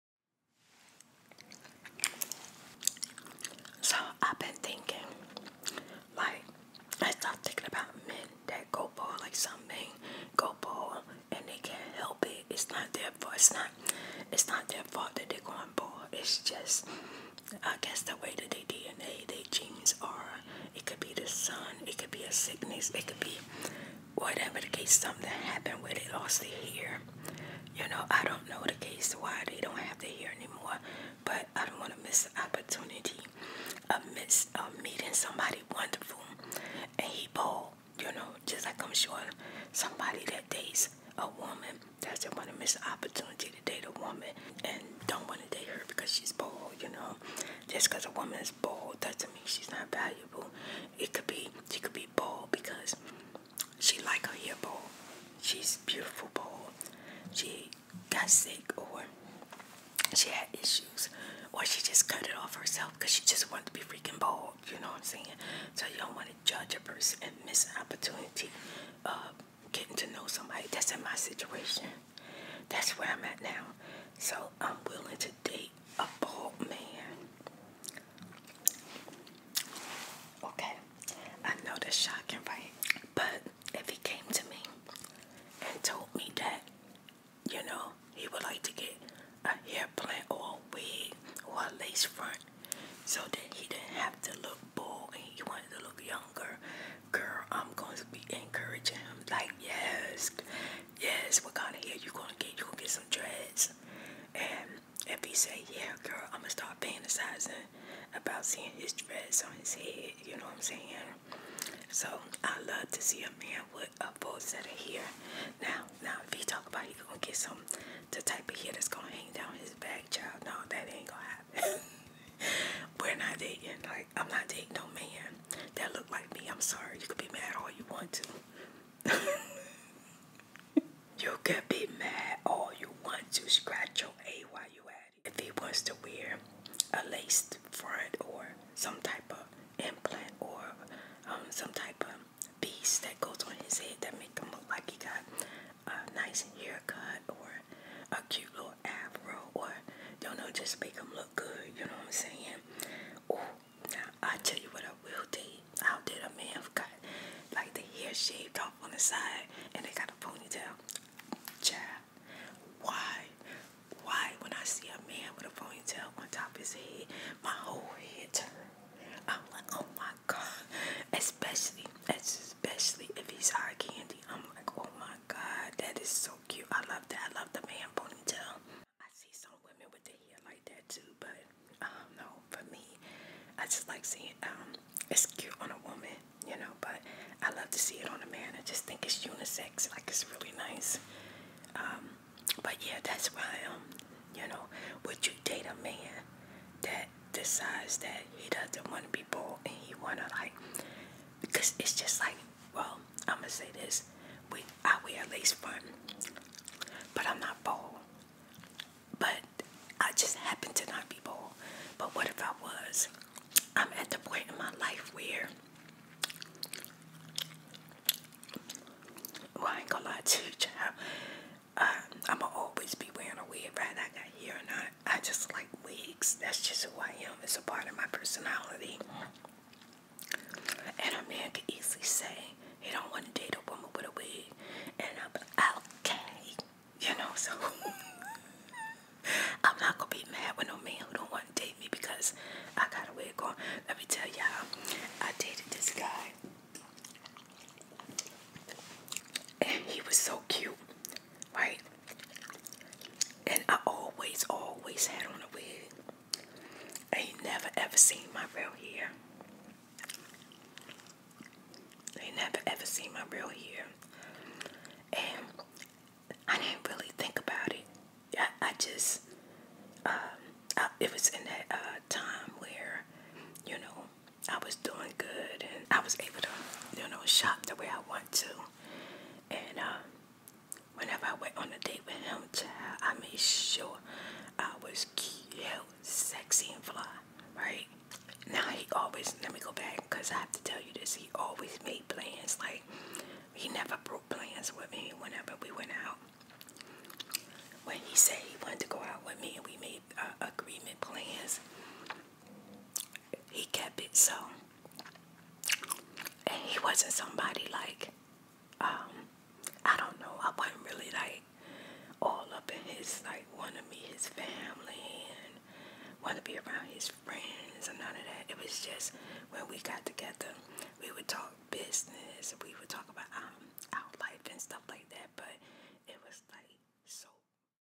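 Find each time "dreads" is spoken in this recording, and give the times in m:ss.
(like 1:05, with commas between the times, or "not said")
1:43, 1:48.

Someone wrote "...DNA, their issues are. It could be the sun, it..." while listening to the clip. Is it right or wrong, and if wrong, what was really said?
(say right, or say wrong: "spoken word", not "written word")
wrong: "genes", not "issues".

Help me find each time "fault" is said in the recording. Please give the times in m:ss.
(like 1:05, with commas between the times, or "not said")
0:14.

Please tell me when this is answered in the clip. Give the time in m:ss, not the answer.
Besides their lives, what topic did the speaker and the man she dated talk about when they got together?
5:21.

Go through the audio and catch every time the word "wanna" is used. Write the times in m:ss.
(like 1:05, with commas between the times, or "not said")
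3:20.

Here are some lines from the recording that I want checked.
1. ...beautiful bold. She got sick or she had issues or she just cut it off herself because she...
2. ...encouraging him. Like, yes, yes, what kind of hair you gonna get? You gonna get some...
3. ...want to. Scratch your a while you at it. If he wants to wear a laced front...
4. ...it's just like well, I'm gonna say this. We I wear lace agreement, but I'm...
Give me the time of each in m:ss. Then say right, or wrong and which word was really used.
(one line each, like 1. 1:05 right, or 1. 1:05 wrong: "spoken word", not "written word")
1. 0:55 right
2. 1:38 right
3. 2:13 right
4. 3:21 wrong: "front", not "agreement".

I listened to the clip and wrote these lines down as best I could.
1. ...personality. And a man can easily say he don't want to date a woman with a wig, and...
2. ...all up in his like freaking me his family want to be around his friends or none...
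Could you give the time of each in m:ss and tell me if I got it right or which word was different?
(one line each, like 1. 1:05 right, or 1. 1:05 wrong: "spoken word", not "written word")
1. 3:48 right
2. 5:12 wrong: "wanting", not "freaking".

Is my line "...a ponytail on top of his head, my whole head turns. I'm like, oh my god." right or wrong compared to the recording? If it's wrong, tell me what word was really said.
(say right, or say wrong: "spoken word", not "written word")
right.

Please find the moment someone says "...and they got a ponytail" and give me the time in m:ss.
2:39.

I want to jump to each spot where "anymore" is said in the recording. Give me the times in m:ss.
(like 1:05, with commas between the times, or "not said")
0:30.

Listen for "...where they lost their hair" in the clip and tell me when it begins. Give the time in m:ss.
0:25.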